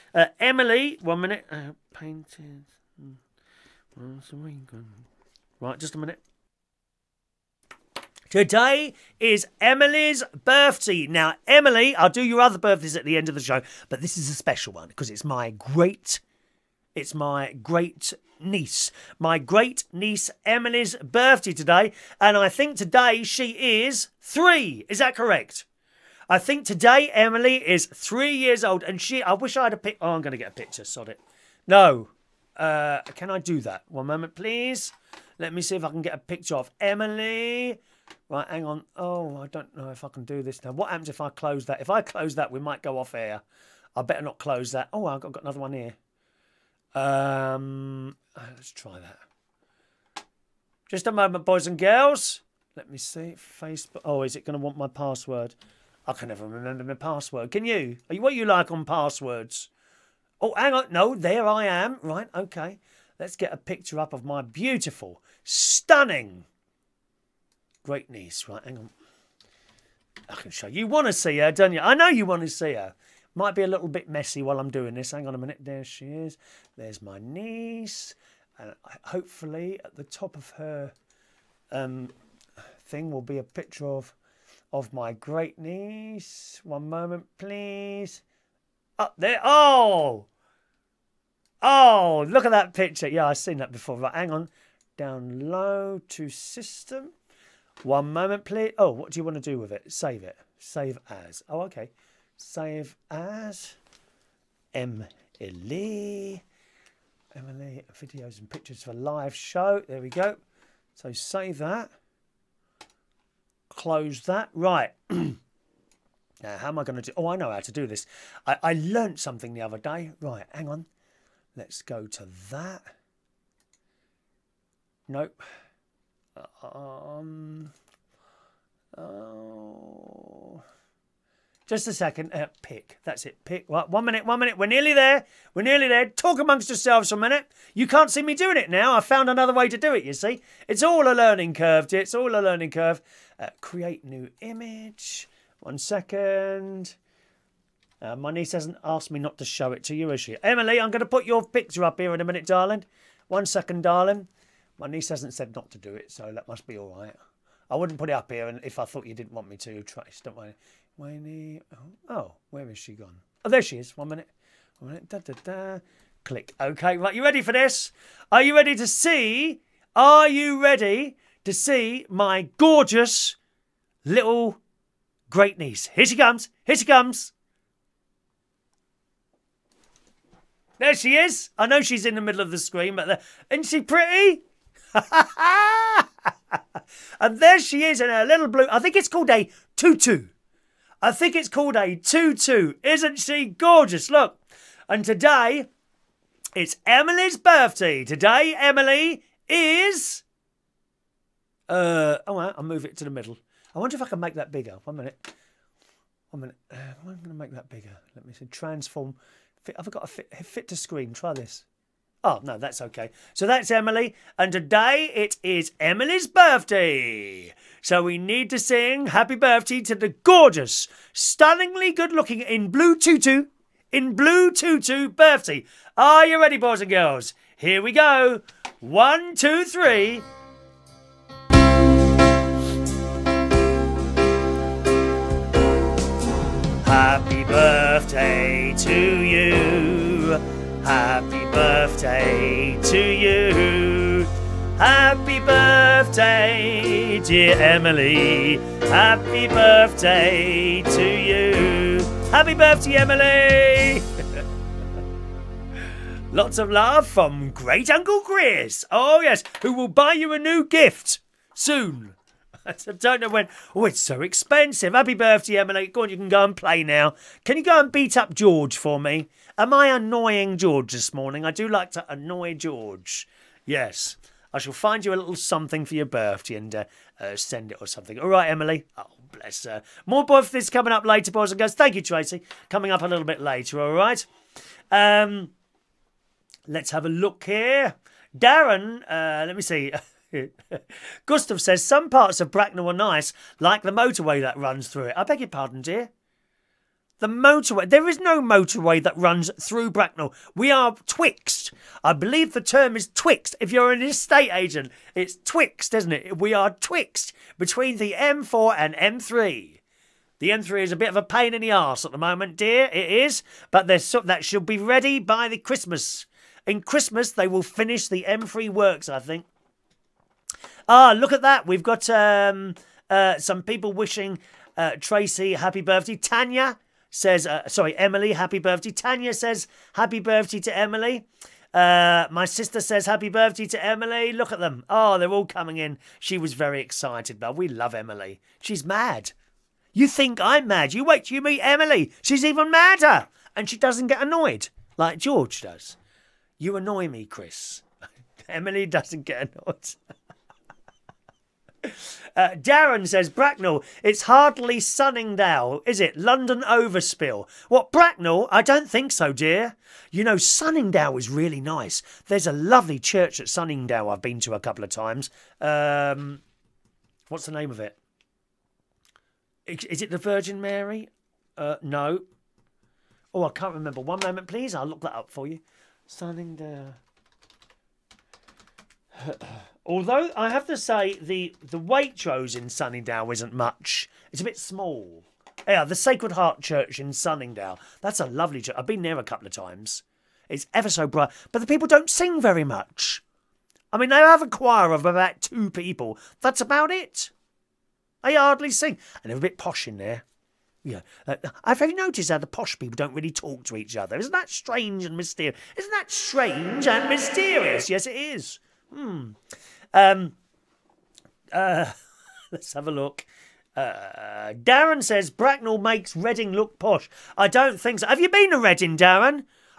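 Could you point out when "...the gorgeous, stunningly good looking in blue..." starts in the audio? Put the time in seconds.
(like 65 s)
219 s.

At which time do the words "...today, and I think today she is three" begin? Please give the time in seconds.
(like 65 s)
21 s.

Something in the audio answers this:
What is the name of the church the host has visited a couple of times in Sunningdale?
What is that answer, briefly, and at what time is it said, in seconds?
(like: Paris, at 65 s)
Sacred Heart Church, at 385 s.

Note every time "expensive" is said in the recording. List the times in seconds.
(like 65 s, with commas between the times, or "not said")
264 s.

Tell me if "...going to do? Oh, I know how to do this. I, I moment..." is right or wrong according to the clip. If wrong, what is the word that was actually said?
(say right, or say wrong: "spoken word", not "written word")
wrong: "learnt", not "moment".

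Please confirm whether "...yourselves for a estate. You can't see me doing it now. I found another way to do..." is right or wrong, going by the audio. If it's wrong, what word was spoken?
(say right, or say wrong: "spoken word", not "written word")
wrong: "minute", not "estate".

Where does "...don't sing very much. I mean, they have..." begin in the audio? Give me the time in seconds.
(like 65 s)
391 s.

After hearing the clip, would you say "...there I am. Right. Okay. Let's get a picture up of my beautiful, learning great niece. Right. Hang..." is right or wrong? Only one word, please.
wrong.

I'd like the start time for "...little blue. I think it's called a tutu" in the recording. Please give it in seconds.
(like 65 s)
188 s.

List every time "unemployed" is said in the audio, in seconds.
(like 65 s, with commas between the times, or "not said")
not said.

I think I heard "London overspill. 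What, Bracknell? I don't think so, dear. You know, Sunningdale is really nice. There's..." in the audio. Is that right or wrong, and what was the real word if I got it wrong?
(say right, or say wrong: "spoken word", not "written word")
right.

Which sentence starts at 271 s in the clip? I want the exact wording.
I do like to annoy George.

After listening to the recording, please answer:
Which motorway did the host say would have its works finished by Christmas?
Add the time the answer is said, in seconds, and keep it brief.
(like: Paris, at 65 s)
M3, at 317 s.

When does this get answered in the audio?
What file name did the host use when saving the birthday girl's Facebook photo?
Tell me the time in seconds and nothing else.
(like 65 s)
102 s.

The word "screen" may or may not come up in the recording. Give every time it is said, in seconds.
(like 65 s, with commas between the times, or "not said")
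182 s, 210 s.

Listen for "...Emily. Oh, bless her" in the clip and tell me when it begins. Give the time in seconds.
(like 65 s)
278 s.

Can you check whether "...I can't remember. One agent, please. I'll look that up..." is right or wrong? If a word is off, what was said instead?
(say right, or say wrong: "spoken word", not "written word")
wrong: "moment", not "agent".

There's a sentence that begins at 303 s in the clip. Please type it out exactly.
If you're an estate agent, it's twixt, isn't it?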